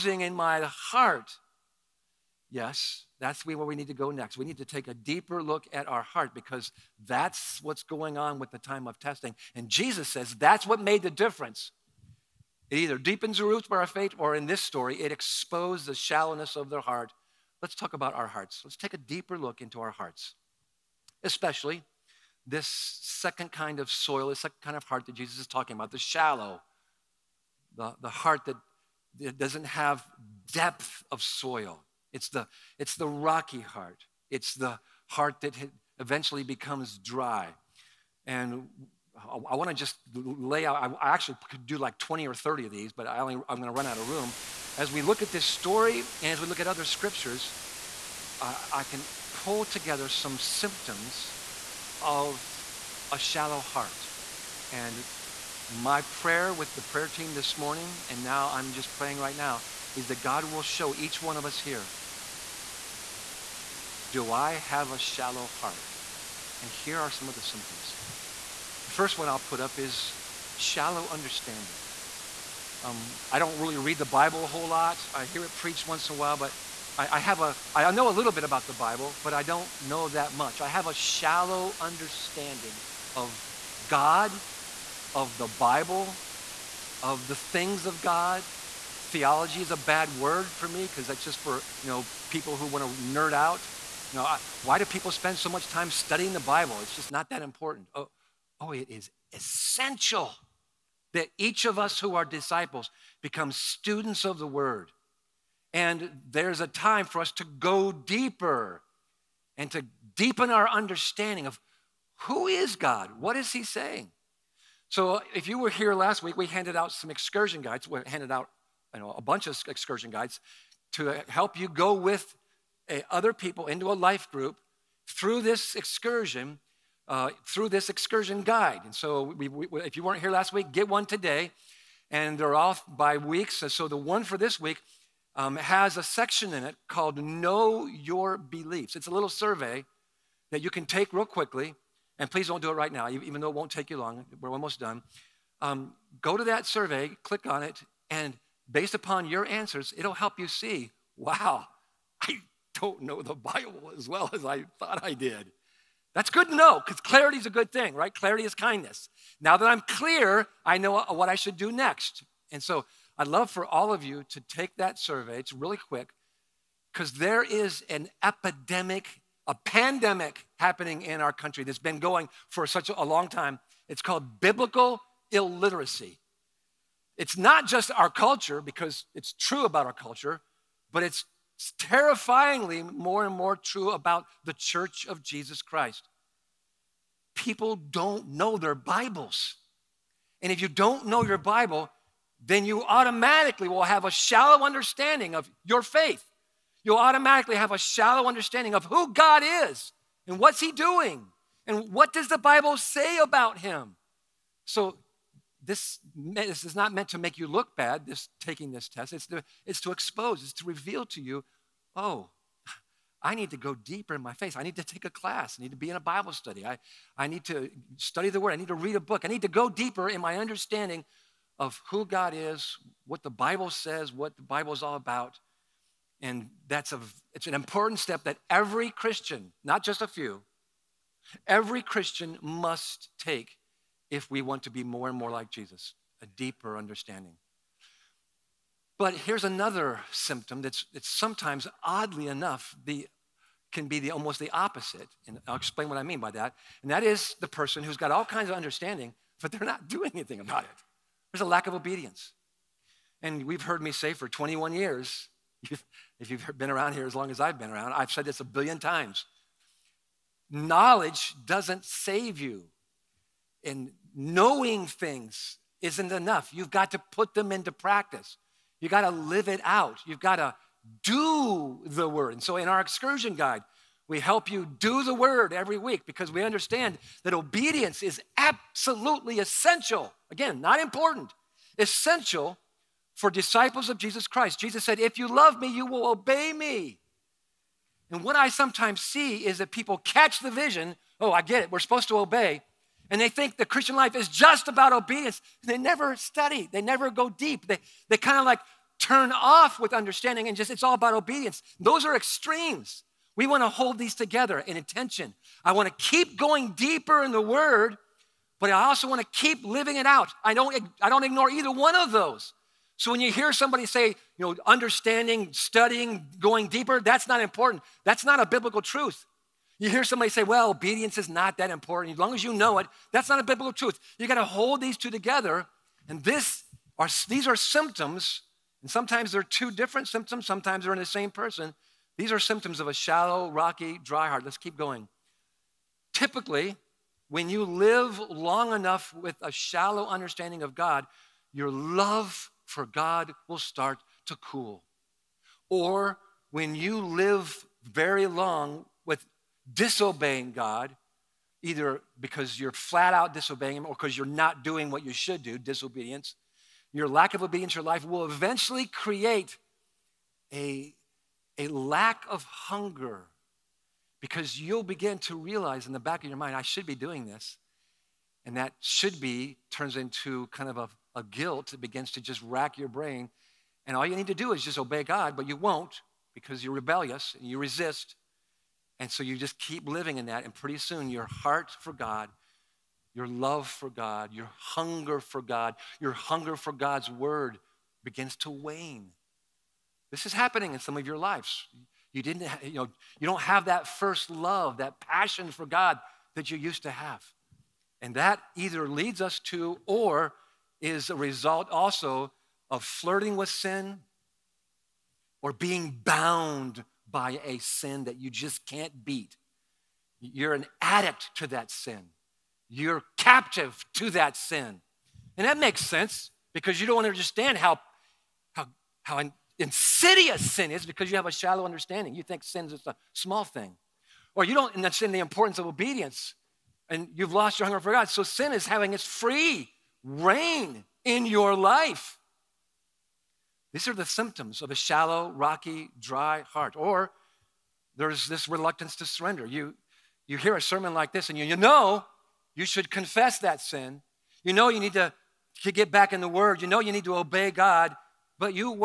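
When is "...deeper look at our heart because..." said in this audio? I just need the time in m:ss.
0:04.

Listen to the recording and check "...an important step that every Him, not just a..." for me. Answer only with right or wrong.
wrong.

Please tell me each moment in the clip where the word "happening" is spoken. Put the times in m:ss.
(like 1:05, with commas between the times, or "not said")
2:50, 6:30.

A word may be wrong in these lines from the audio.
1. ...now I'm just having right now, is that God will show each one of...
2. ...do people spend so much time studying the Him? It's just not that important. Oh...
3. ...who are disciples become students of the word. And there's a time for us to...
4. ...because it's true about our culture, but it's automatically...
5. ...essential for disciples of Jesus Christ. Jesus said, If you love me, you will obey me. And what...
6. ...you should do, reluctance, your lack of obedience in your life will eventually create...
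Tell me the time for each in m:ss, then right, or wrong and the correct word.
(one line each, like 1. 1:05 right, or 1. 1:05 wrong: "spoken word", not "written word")
1. 0:58 wrong: "praying", not "having"
2. 1:34 wrong: "Bible", not "Him"
3. 1:41 right
4. 2:58 wrong: "terrifyingly", not "automatically"
5. 4:41 right
6. 5:55 wrong: "disobedience", not "reluctance".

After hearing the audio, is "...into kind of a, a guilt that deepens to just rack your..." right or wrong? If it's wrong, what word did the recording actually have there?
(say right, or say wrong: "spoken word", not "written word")
wrong: "begins", not "deepens".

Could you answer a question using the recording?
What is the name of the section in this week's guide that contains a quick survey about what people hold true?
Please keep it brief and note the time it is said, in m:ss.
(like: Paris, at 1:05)
Know Your Beliefs, at 2:17.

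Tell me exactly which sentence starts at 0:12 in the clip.
It either deepens the roots of our faith, or in this story, it exposed the shallowness of their heart.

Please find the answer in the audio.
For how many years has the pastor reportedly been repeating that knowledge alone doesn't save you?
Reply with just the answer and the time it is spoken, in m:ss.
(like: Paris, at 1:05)
21, at 4:14.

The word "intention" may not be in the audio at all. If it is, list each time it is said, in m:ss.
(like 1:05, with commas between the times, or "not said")
5:04.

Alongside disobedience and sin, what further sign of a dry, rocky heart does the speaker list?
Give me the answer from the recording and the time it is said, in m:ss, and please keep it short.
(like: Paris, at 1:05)
Reluctance to surrender, at 7:18.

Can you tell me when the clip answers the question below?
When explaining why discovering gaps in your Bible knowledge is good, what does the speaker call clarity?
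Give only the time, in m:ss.
2:38.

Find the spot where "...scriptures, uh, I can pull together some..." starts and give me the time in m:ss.
0:46.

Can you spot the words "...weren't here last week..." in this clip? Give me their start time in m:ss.
2:10.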